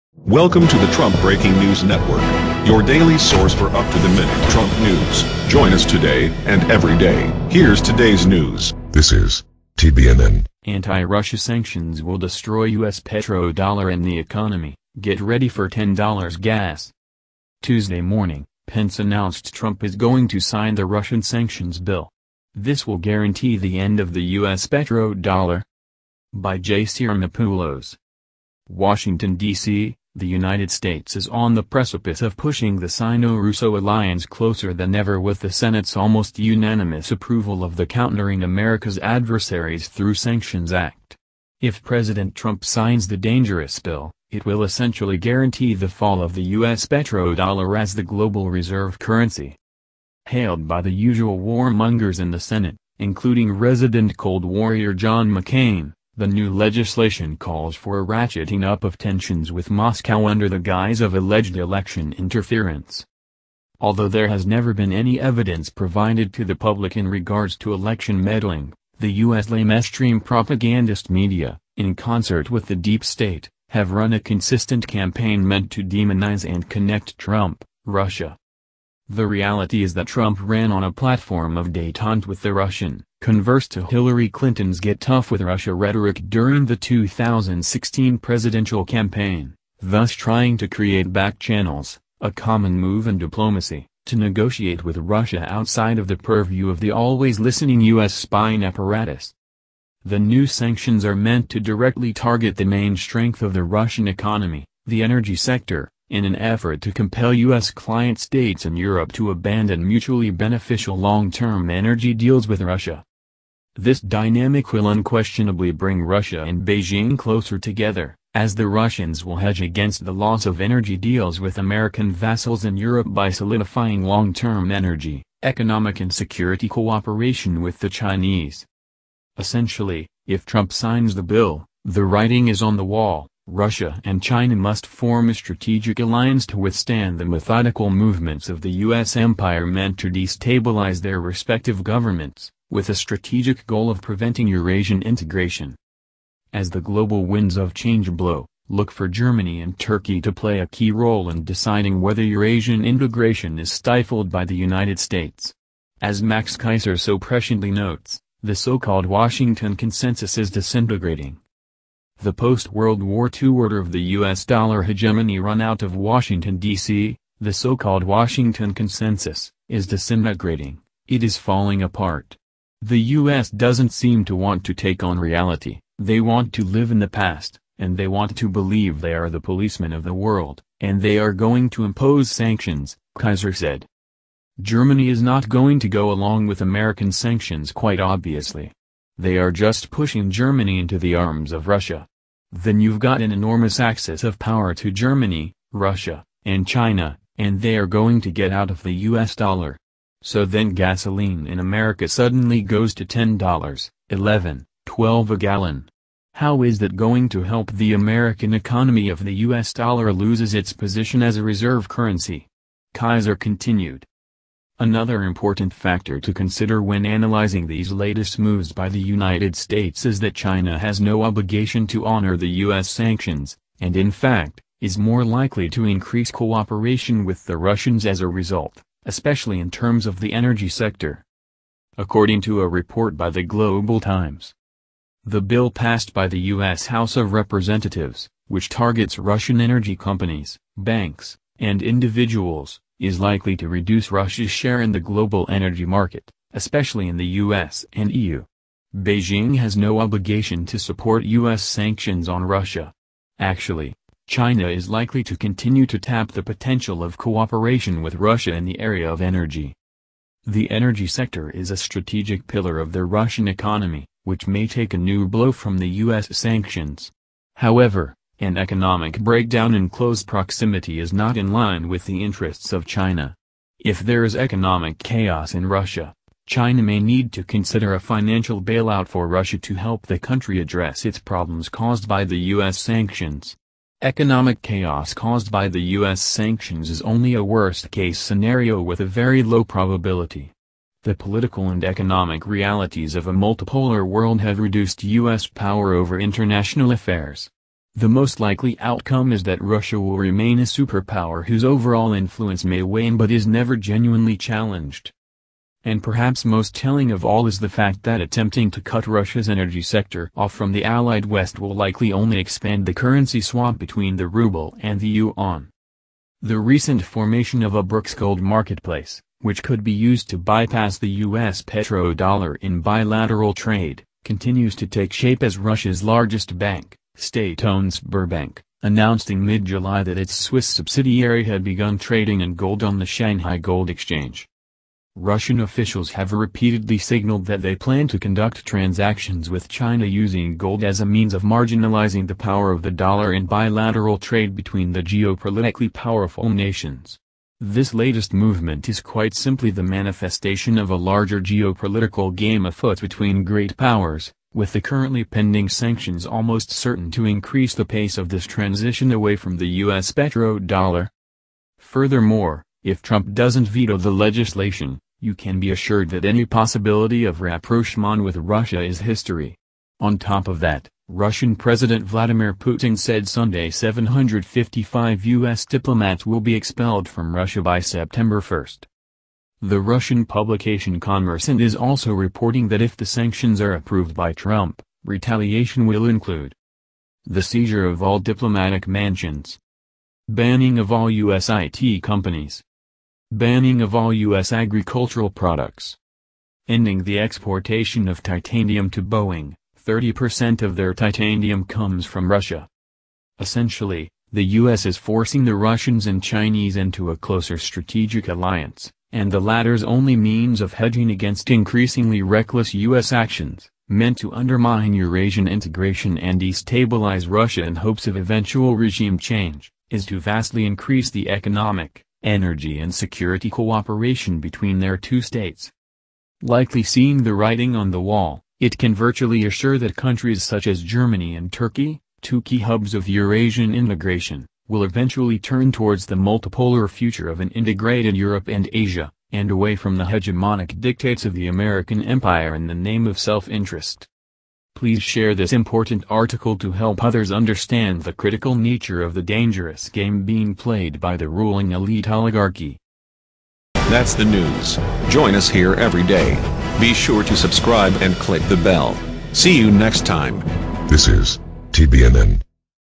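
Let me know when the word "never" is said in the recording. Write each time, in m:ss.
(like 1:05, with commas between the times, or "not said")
1:04, 5:03.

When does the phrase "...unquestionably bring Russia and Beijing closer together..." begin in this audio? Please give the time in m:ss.
1:54.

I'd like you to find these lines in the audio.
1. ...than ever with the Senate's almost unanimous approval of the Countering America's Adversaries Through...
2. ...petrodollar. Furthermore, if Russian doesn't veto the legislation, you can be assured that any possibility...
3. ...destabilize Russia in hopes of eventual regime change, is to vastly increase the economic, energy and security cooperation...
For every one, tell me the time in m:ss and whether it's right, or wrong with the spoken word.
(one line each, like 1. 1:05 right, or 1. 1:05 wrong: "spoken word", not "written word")
1. 0:34 right
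2. 6:00 wrong: "Trump", not "Russian"
3. 6:56 right.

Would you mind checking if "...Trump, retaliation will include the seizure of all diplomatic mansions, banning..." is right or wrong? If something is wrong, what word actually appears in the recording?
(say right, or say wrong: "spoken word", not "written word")
right.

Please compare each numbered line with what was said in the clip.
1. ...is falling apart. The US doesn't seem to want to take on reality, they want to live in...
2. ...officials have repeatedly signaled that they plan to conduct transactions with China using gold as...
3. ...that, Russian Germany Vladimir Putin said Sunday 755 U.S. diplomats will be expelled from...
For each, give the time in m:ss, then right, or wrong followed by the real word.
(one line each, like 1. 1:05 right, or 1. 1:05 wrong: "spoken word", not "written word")
1. 2:51 right
2. 5:35 right
3. 6:10 wrong: "President", not "Germany".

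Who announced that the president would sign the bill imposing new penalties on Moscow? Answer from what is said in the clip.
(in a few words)
Pence.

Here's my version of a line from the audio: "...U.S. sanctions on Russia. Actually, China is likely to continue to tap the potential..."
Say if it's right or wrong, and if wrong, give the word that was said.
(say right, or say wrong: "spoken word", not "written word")
right.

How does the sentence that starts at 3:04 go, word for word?
Germany is not going to go along with American sanctions quite obviously.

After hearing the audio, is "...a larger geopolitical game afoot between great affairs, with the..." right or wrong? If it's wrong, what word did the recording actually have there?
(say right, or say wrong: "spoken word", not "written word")
wrong: "powers", not "affairs".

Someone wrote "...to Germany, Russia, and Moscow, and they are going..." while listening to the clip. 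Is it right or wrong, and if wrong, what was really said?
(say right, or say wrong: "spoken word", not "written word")
wrong: "China", not "Moscow".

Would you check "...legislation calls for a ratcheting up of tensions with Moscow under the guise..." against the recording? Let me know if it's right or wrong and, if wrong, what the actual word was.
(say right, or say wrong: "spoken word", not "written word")
right.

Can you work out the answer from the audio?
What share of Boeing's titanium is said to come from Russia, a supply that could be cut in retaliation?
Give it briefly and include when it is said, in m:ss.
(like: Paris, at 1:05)
30%, at 6:39.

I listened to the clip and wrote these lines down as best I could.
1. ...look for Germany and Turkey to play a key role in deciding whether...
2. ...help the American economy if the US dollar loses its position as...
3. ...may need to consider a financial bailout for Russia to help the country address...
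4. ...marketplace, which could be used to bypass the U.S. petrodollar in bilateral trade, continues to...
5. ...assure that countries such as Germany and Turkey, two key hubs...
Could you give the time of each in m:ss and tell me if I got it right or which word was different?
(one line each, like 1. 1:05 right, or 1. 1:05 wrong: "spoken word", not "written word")
1. 2:28 right
2. 3:27 right
3. 4:36 right
4. 5:18 right
5. 7:09 right.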